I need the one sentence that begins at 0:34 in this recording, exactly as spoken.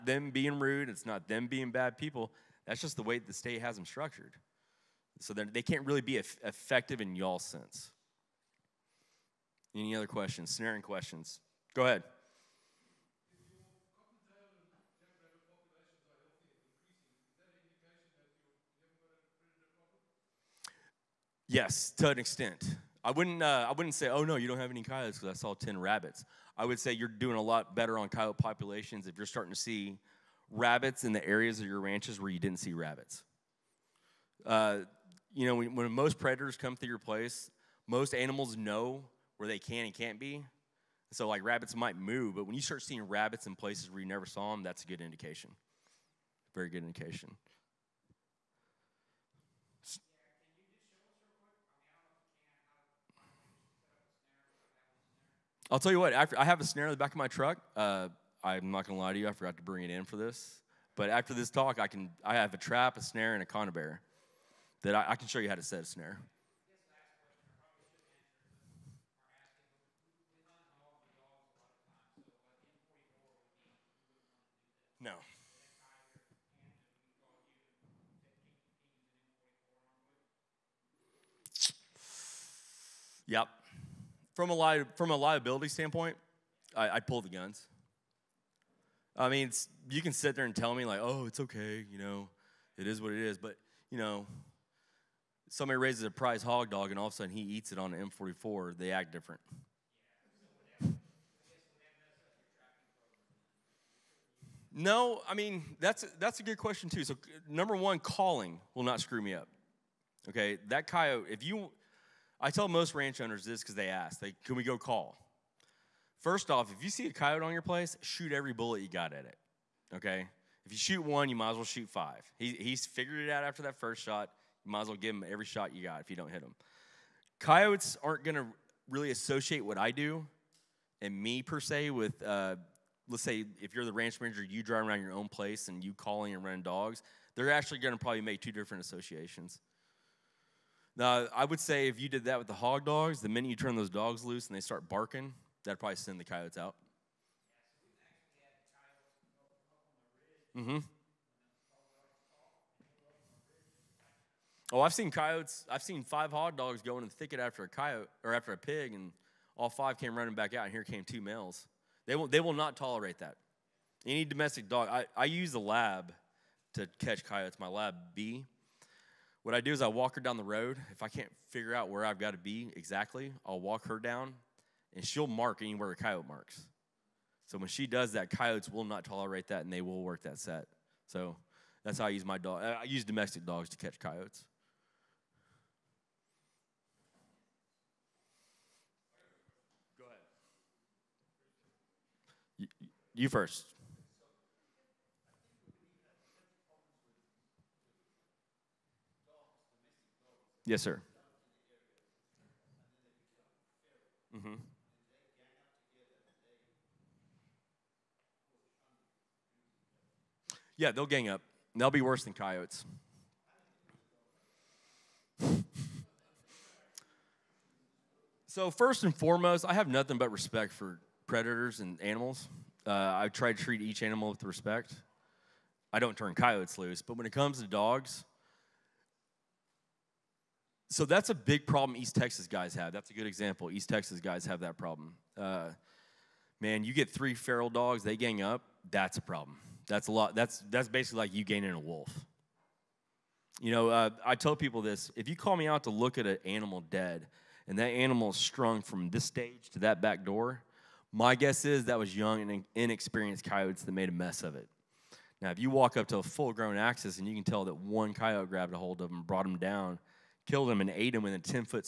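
Uh, you know, when, when most predators come through your place, most animals know where they can and can't be.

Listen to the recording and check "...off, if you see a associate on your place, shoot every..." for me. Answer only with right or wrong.
wrong.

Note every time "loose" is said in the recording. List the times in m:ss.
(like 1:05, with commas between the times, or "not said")
2:24, 3:46.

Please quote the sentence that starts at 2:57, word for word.
So when she does that, coyotes will not tolerate that, and they will work that set.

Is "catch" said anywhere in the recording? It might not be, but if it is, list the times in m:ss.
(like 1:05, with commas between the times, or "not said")
2:46, 3:03.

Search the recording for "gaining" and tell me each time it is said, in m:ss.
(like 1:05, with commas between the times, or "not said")
4:01.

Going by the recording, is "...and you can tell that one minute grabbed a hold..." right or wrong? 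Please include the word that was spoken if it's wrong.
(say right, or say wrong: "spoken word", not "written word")
wrong: "coyote", not "minute".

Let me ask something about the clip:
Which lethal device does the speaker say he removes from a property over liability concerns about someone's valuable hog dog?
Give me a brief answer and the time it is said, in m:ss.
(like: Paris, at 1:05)
M44, at 1:38.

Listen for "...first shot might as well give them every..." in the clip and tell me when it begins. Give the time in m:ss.
2:03.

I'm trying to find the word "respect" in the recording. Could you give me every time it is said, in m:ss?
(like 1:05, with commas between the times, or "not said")
3:40, 3:44.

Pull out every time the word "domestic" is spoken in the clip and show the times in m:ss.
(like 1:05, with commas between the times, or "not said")
2:44, 3:03.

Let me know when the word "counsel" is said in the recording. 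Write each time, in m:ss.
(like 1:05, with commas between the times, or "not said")
not said.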